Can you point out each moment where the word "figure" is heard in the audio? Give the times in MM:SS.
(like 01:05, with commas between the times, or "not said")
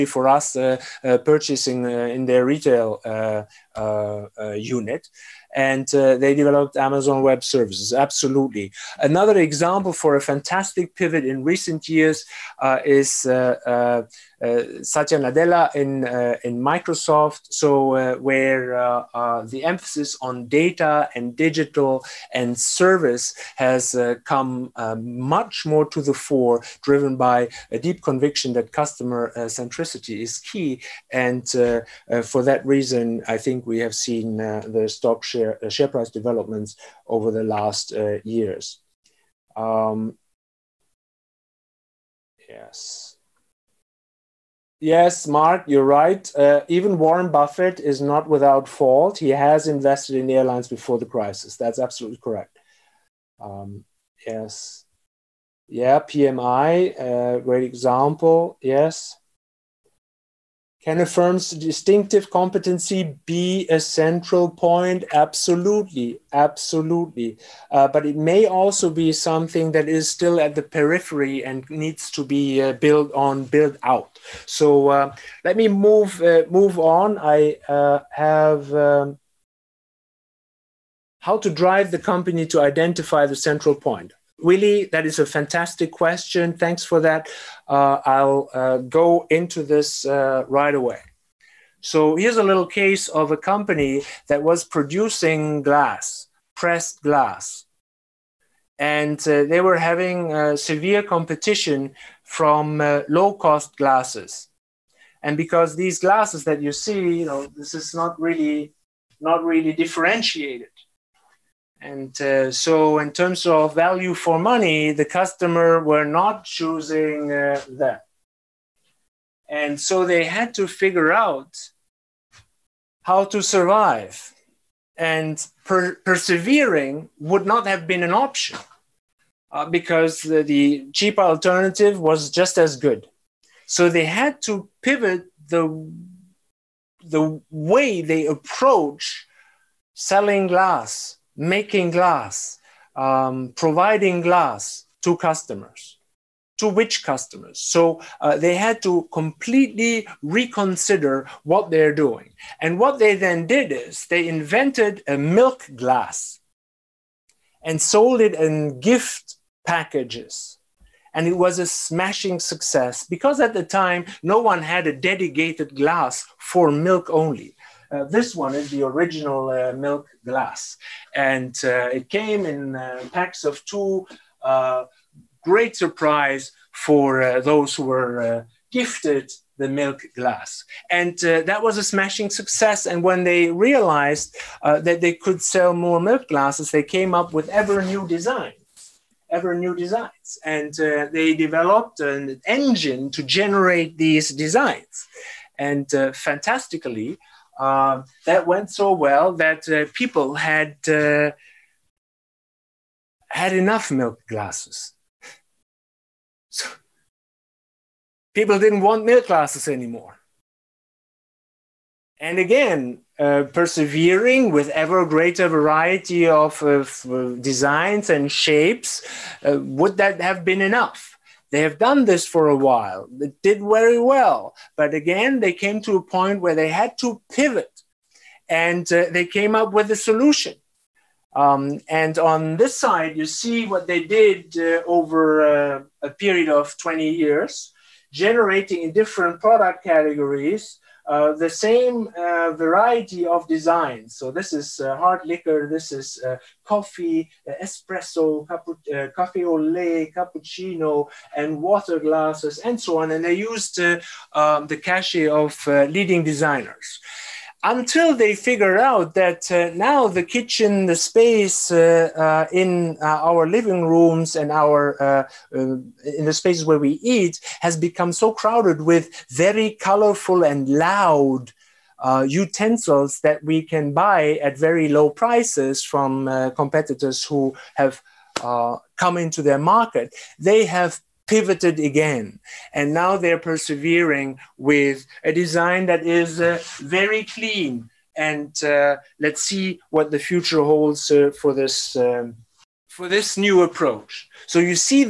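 02:00, 04:18.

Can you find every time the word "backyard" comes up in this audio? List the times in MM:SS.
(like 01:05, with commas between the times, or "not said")
not said.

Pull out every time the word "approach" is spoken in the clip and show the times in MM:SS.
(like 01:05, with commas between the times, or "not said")
02:18, 04:53.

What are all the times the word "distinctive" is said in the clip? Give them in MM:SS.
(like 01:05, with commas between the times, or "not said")
01:01.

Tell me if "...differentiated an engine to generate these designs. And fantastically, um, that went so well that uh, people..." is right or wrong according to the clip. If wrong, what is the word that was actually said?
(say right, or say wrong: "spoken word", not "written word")
wrong: "developed", not "differentiated".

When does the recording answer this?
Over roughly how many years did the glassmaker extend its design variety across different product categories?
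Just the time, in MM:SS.
03:56.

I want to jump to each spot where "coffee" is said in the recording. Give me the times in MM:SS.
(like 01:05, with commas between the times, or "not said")
04:06.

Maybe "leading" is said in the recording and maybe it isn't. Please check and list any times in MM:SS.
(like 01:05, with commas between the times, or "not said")
04:15.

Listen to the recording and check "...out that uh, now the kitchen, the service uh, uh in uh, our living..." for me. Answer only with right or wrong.
wrong.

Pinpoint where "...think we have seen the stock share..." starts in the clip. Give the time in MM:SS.
00:33.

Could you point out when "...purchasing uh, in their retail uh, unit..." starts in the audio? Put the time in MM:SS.
00:01.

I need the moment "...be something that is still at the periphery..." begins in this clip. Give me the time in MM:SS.
01:08.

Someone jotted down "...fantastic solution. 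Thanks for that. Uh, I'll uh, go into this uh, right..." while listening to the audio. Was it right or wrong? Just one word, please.
wrong.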